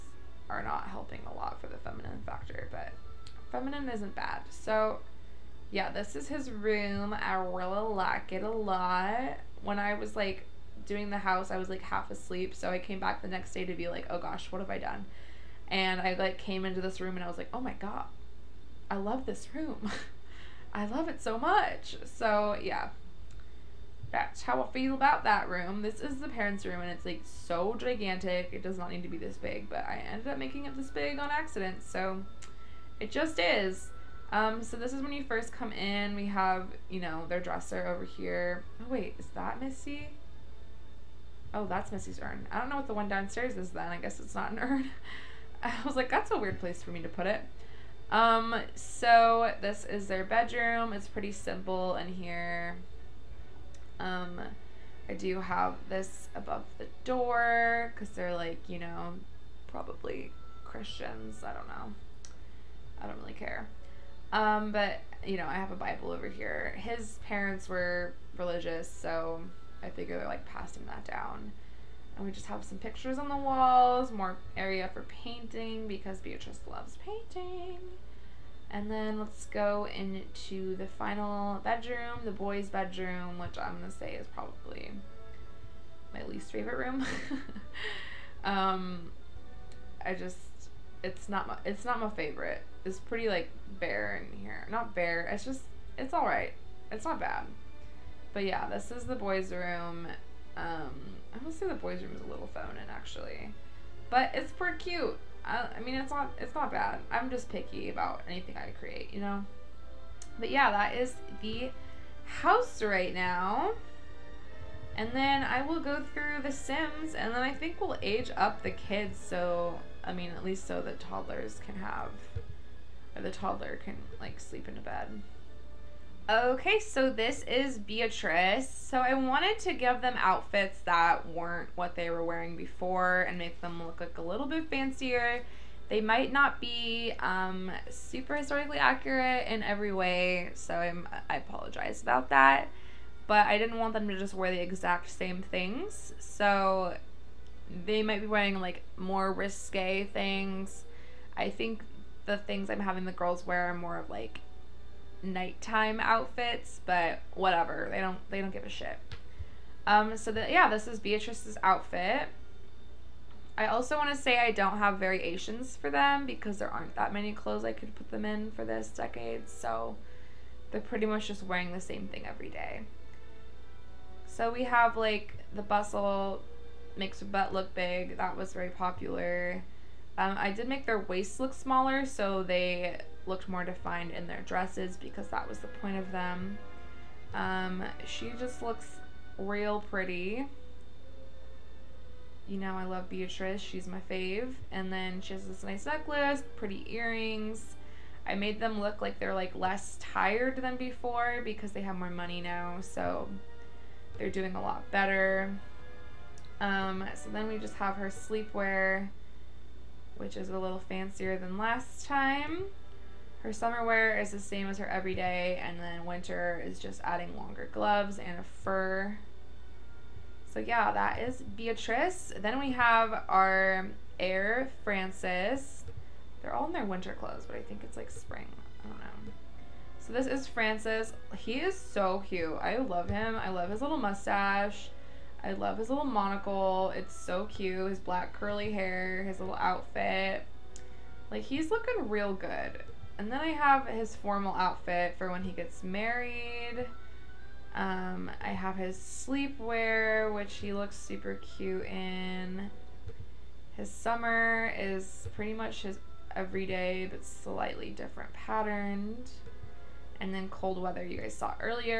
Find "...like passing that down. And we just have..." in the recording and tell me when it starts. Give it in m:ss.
1:10.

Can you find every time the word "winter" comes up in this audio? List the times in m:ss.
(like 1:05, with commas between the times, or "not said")
3:36, 3:46.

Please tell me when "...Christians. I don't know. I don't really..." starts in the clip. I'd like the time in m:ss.
1:00.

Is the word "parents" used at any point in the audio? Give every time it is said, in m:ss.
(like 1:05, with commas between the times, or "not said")
0:26, 1:07.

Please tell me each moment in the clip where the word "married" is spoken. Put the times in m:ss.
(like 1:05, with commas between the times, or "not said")
4:05.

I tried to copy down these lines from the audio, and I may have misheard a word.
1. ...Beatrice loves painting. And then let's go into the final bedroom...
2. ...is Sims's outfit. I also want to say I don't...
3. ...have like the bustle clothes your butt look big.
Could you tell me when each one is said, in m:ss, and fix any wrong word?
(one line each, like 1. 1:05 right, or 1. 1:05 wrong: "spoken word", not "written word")
1. 1:16 right
2. 2:40 wrong: "Beatrice", not "Sims"
3. 2:54 wrong: "makes", not "clothes".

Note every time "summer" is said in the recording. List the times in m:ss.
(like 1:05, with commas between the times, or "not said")
3:33, 4:13.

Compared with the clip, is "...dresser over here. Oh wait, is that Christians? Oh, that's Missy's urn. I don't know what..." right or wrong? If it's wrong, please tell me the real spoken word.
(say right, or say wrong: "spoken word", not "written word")
wrong: "Missy", not "Christians".